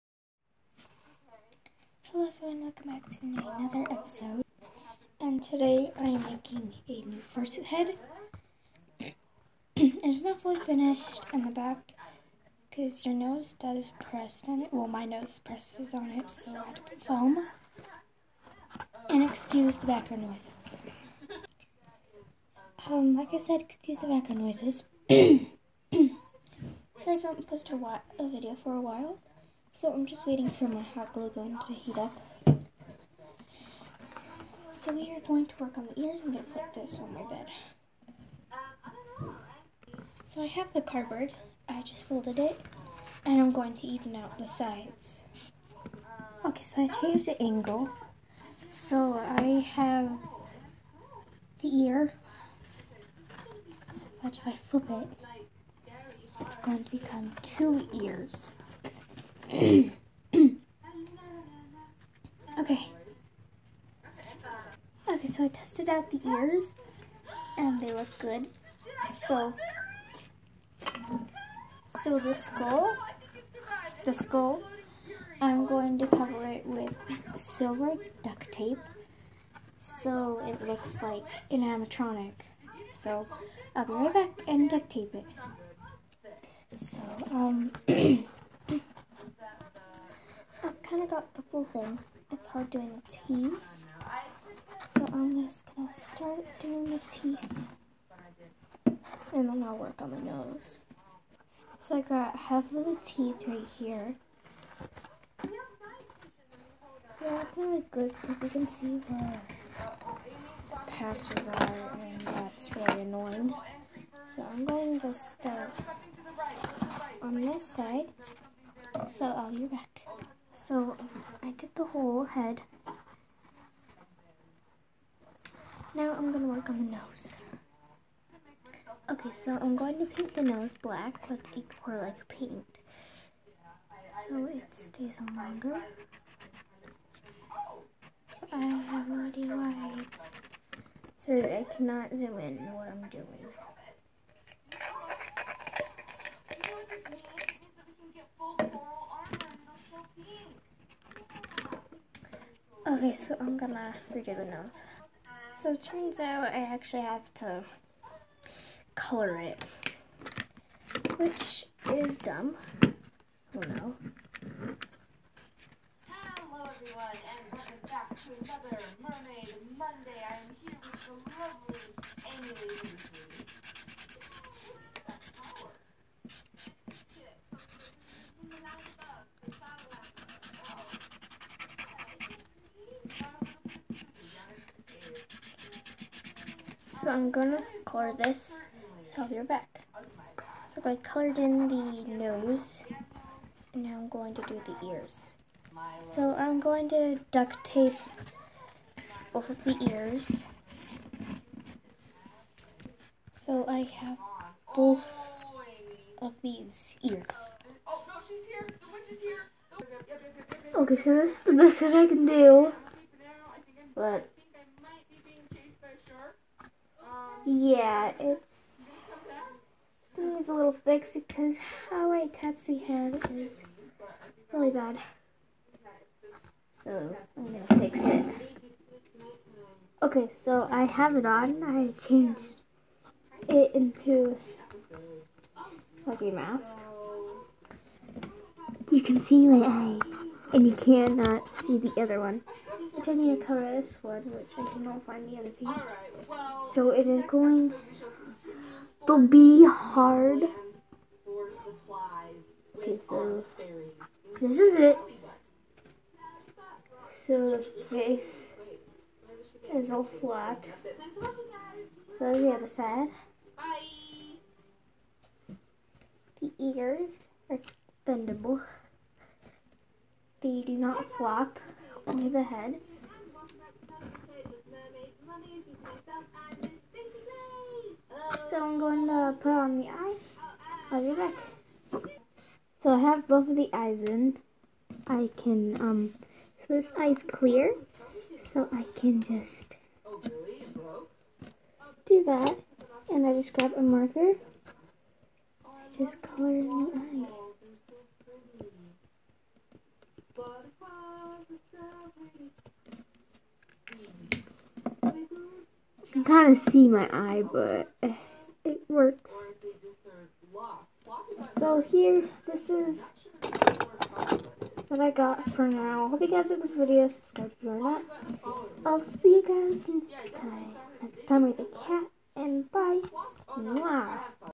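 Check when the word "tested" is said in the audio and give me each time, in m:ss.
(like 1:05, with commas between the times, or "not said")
1:05.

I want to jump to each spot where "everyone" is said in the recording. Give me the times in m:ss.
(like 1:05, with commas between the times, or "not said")
0:02, 2:46.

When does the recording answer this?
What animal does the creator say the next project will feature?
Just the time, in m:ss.
5:21.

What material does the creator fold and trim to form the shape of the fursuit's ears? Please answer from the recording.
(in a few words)
cardboard.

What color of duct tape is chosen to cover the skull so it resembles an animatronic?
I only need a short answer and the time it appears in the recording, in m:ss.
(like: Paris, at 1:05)
silver, at 1:17.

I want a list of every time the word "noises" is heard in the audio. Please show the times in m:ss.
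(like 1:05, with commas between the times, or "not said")
0:20, 0:24.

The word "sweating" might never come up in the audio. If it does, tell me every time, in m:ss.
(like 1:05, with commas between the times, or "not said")
not said.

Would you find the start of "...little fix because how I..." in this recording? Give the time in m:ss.
3:40.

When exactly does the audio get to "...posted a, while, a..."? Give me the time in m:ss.
0:27.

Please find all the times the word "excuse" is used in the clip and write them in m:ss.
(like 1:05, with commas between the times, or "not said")
0:19, 0:23.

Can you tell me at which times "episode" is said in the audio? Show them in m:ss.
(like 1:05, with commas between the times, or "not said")
0:03.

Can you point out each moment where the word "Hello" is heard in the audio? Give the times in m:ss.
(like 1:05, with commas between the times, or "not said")
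0:02, 2:46.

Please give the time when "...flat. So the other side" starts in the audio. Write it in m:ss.
4:20.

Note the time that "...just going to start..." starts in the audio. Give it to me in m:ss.
1:35.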